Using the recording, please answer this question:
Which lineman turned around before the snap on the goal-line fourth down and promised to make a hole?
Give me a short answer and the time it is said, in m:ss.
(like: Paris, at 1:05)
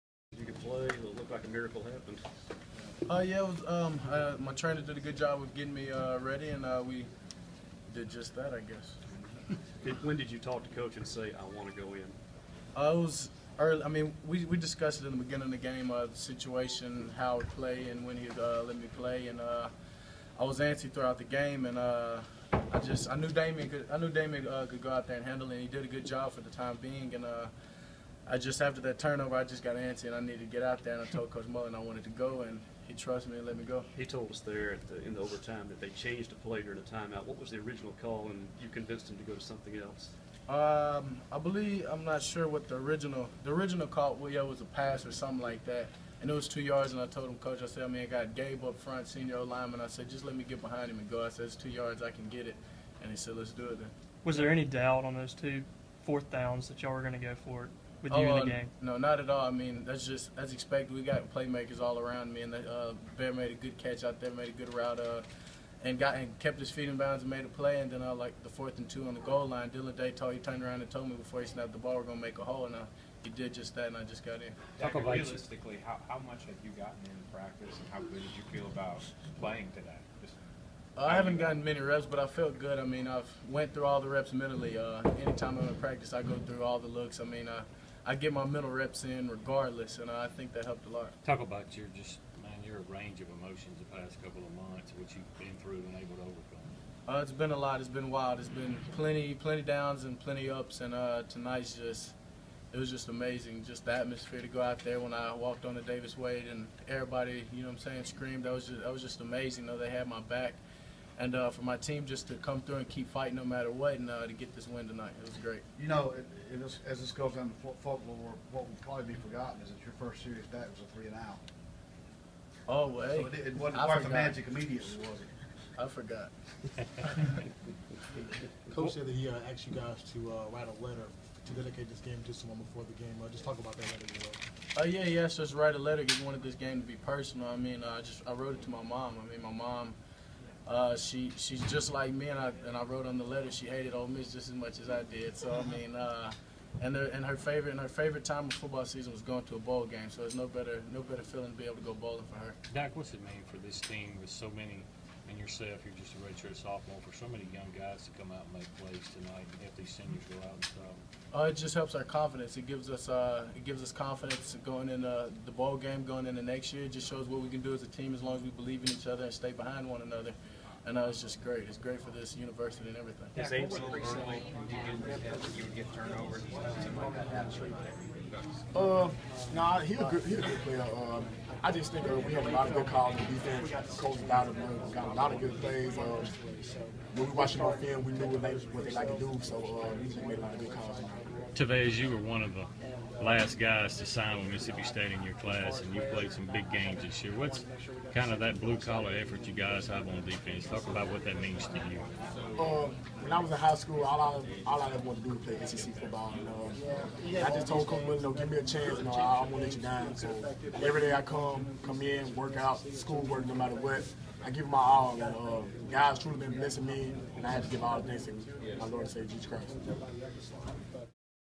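Dillon Day, at 1:09.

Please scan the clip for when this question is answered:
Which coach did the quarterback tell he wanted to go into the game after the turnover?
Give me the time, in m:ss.
0:31.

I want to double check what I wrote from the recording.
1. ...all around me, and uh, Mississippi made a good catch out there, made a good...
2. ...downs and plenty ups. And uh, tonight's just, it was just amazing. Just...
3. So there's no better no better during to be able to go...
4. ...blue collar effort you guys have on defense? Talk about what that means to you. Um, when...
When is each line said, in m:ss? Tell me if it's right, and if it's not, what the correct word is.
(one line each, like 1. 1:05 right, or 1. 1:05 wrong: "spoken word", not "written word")
1. 1:01 wrong: "Bear", not "Mississippi"
2. 1:39 right
3. 2:30 wrong: "feeling", not "during"
4. 3:18 right.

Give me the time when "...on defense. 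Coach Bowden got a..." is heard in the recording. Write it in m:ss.
3:03.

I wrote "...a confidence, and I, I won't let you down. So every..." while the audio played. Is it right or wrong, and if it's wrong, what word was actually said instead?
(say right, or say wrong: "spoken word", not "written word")
wrong: "chance", not "confidence".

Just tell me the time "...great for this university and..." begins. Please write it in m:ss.
2:51.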